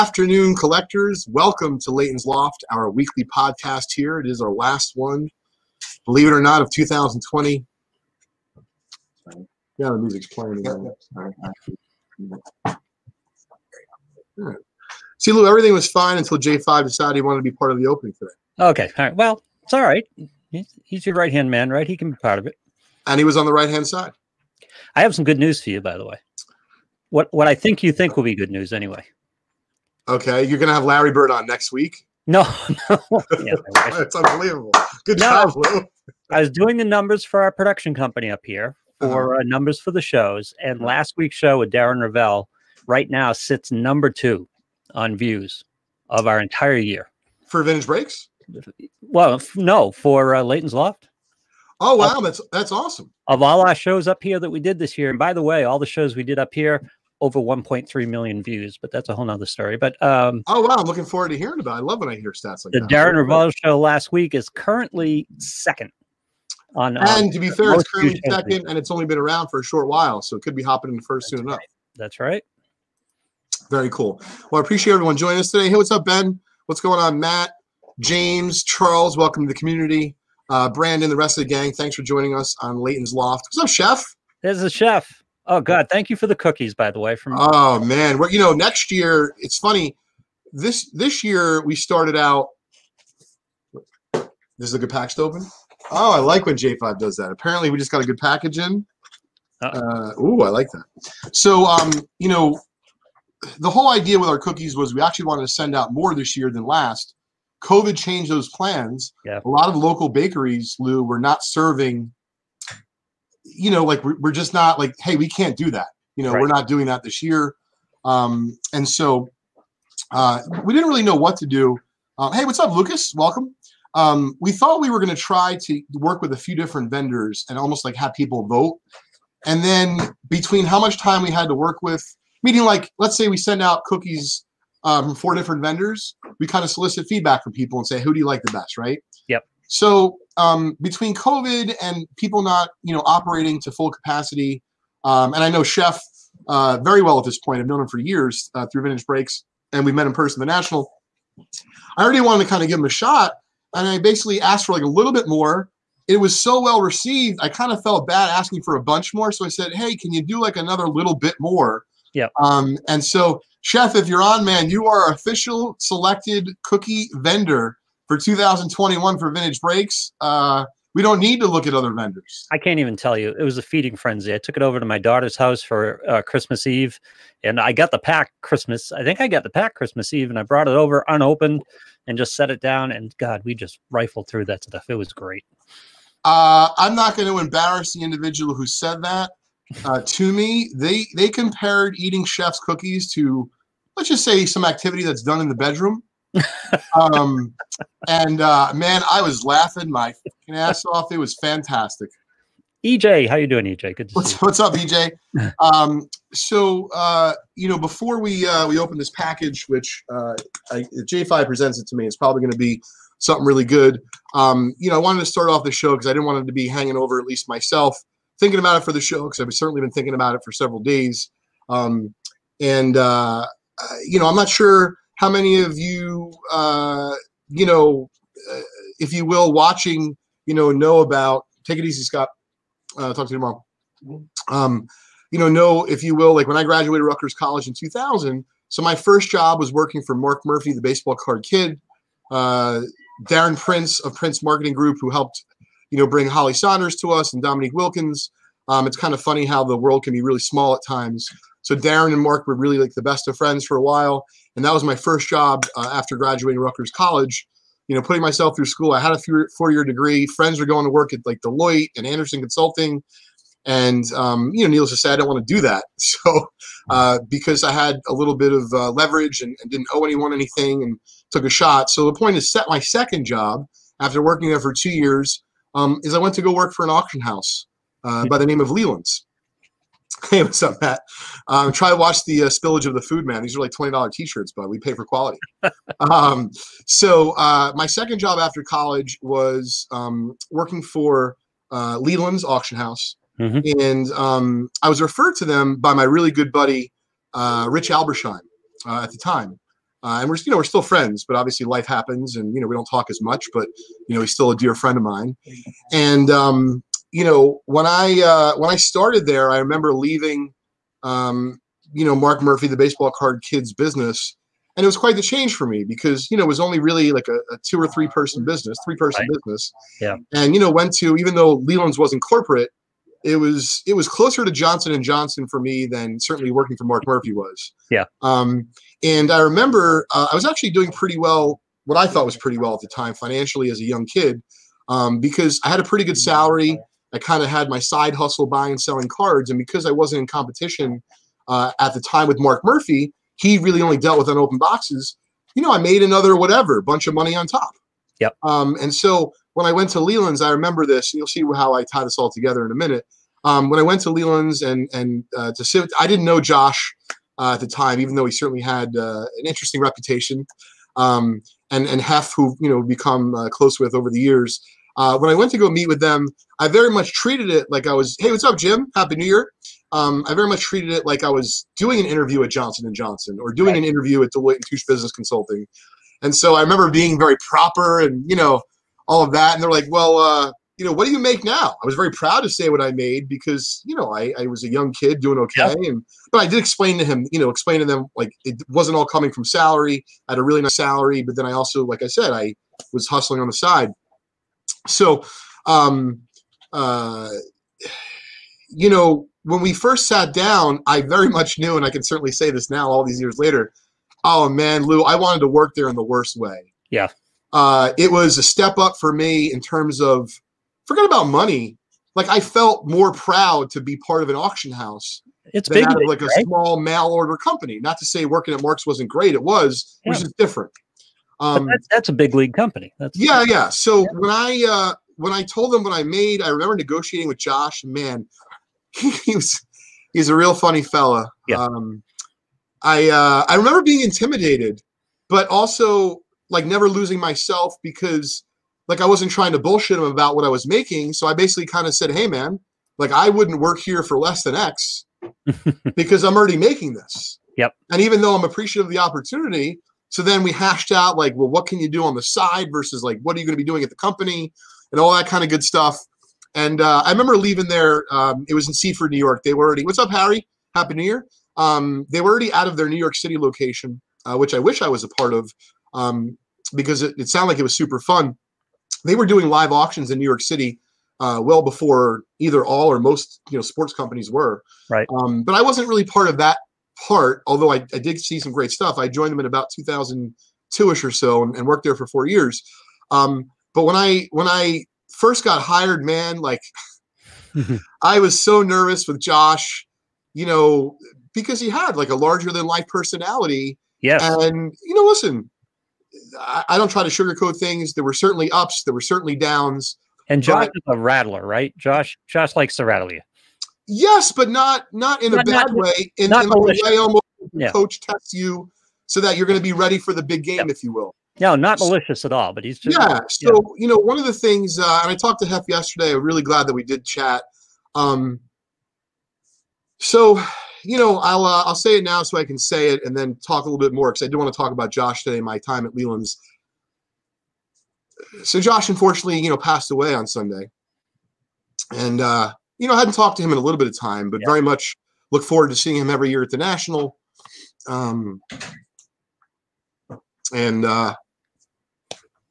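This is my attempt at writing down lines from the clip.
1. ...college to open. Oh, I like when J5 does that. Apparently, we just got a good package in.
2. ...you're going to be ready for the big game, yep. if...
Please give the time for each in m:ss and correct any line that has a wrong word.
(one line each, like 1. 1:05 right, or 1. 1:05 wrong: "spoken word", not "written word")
1. 1:34 wrong: "package", not "college"
2. 8:29 right.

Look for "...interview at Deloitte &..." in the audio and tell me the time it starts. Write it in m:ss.
6:13.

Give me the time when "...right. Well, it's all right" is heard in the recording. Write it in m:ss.
0:19.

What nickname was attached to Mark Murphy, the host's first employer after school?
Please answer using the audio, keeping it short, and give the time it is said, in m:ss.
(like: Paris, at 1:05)
the baseball card kid, at 4:00.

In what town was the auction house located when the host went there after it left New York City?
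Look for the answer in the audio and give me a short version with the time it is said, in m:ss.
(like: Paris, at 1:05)
Seaford, New York, at 7:38.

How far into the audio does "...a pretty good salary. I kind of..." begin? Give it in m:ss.
5:35.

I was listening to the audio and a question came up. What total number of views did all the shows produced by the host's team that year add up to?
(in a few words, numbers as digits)
over 1.3 million.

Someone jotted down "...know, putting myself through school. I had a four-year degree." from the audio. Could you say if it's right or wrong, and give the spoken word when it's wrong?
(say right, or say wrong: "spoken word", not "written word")
right.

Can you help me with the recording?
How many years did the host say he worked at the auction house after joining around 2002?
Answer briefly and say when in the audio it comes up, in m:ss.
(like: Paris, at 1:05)
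4, at 8:02.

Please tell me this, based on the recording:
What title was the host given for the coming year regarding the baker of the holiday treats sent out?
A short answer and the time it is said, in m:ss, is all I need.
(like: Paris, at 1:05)
official selected cookie vendor, at 2:45.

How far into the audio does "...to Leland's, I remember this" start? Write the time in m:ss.
5:49.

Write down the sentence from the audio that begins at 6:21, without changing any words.
I was very proud to say what I made because, you know, I, I was a young kid doing okay.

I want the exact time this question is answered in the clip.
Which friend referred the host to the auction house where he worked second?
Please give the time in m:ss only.
4:57.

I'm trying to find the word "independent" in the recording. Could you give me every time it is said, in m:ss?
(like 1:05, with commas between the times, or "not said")
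not said.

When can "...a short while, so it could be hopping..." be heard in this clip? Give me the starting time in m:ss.
1:09.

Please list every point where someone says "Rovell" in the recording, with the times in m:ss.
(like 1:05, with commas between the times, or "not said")
0:42, 1:03.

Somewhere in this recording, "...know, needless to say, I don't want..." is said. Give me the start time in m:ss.
4:24.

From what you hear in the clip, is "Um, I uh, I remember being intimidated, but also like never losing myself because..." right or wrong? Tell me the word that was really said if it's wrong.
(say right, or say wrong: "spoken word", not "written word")
right.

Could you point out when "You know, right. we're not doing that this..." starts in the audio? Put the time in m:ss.
1:56.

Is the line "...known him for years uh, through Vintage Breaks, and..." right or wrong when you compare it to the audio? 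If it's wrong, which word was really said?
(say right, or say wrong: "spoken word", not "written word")
right.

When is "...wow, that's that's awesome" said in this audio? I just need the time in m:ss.
0:51.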